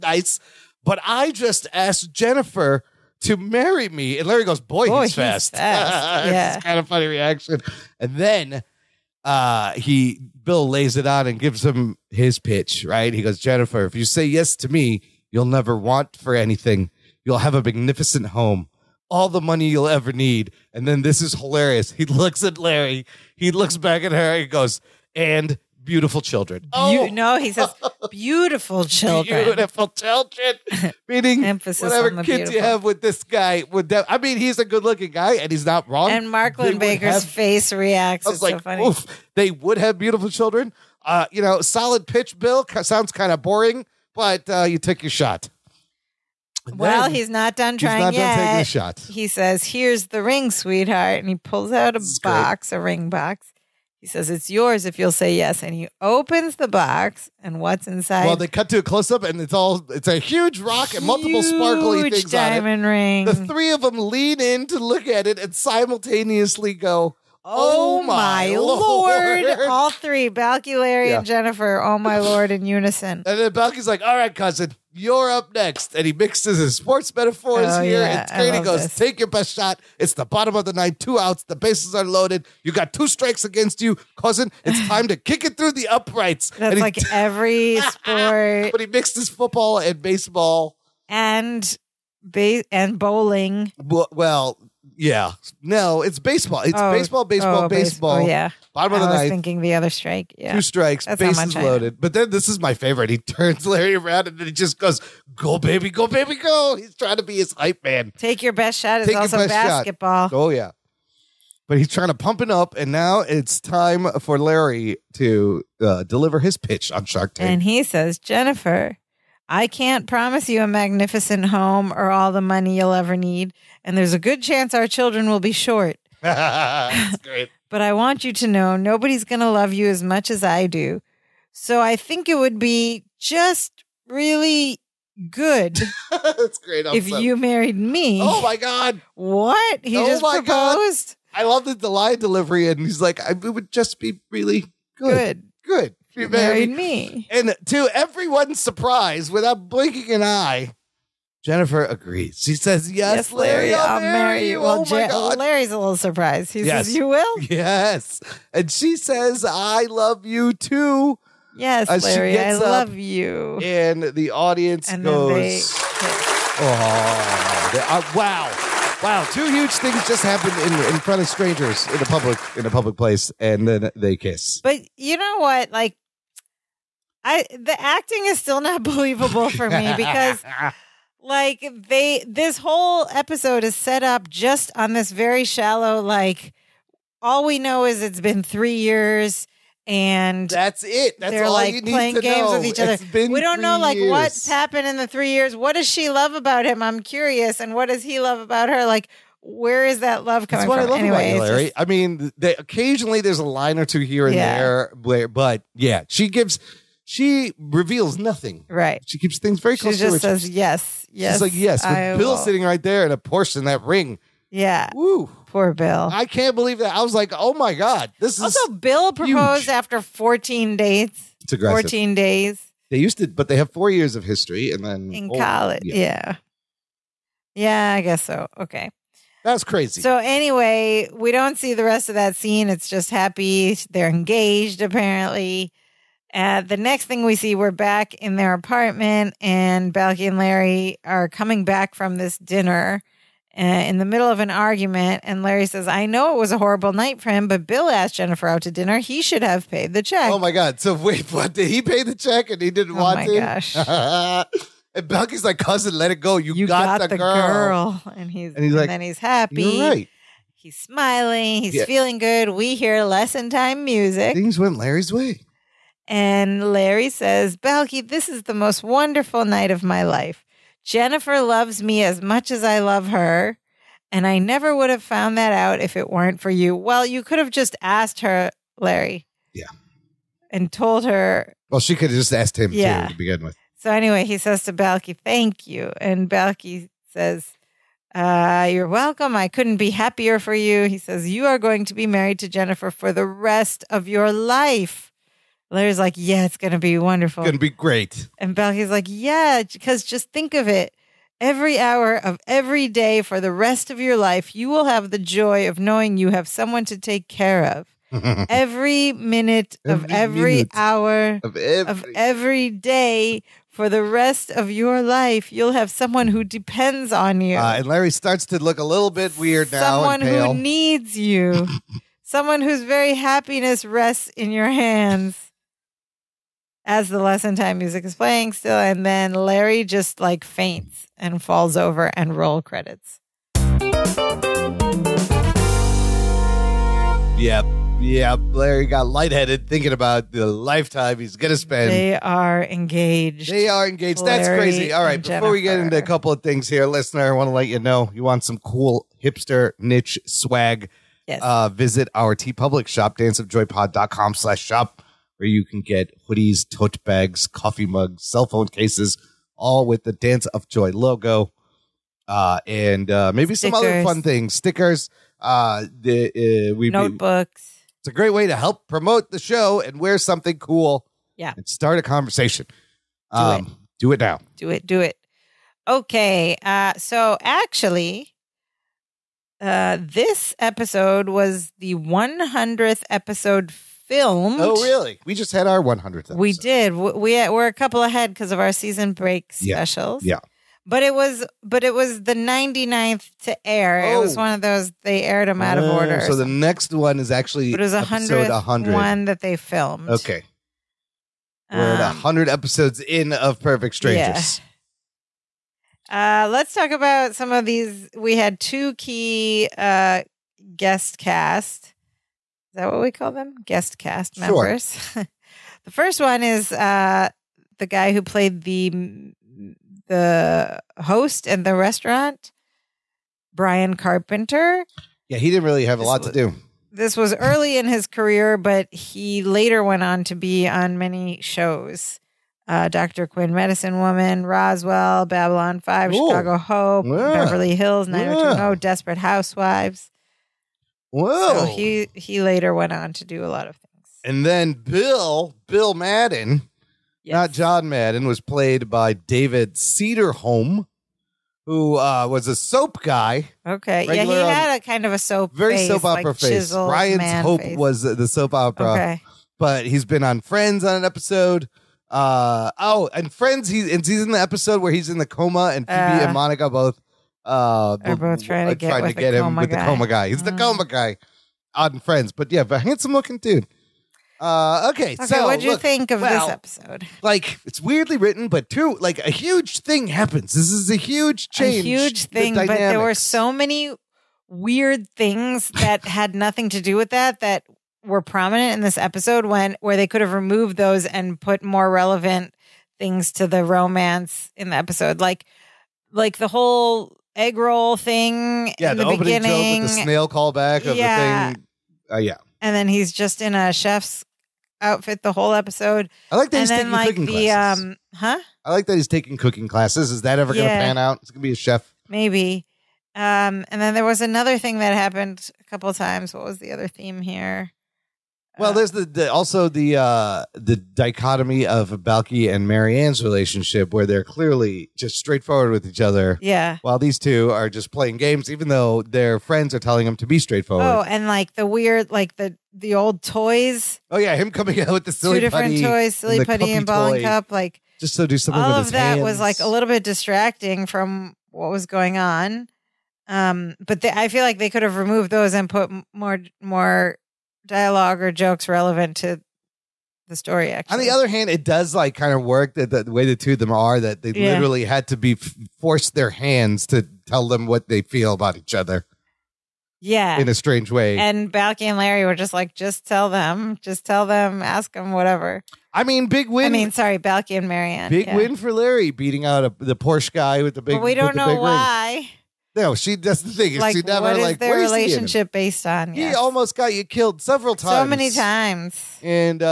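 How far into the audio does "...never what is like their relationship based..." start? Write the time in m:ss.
9:34.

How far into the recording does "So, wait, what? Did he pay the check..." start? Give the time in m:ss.
4:10.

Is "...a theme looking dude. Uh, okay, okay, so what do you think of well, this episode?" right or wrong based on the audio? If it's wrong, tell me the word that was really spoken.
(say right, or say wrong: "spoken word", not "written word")
wrong: "handsome", not "theme".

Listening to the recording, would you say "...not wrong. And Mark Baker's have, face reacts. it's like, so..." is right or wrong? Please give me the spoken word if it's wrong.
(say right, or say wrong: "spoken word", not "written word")
right.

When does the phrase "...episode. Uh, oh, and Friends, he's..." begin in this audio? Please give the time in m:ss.
7:41.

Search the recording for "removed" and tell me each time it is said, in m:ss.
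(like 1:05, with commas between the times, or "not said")
8:10, 9:04.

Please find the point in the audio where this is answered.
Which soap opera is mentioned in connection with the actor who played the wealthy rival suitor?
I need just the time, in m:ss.
7:36.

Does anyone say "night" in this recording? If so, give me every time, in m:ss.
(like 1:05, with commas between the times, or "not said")
4:06, 4:29.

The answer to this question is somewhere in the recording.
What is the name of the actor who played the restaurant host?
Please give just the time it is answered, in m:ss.
7:03.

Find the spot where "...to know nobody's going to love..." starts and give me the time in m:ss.
2:08.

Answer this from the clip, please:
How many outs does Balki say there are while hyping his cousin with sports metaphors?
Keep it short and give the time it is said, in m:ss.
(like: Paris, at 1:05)
2, at 1:20.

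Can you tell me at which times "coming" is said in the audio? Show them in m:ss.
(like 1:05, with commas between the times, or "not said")
3:20, 4:01, 8:54.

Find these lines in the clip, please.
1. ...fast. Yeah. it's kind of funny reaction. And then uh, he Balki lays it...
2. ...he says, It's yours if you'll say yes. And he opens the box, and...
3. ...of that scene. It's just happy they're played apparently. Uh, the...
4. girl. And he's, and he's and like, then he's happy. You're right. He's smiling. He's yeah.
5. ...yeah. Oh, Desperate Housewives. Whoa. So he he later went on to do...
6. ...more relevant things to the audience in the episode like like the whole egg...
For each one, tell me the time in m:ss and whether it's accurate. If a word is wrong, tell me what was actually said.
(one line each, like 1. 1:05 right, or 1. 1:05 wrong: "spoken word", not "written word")
1. 0:05 wrong: "Bill", not "Balki"
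2. 0:54 right
3. 3:52 wrong: "engaged", not "played"
4. 4:18 right
5. 7:18 right
6. 8:11 wrong: "romance", not "audience".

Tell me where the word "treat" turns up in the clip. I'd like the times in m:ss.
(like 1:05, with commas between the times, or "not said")
not said.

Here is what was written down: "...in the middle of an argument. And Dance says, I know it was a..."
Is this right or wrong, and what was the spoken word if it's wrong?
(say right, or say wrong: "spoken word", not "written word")
wrong: "Larry", not "Dance".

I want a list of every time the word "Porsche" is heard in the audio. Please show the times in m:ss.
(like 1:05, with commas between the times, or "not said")
3:33, 9:29.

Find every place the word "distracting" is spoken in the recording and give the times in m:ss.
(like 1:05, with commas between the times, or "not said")
9:00.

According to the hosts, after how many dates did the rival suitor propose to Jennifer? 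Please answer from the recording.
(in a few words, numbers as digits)
14.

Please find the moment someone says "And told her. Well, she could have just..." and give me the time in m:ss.
4:40.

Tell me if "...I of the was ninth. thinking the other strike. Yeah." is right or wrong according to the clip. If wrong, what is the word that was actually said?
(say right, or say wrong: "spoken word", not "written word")
right.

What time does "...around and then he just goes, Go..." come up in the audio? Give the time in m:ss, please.
1:43.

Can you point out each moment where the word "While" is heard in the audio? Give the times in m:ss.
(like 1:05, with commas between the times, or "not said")
8:46.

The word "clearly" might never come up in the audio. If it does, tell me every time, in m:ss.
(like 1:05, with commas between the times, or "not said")
8:44.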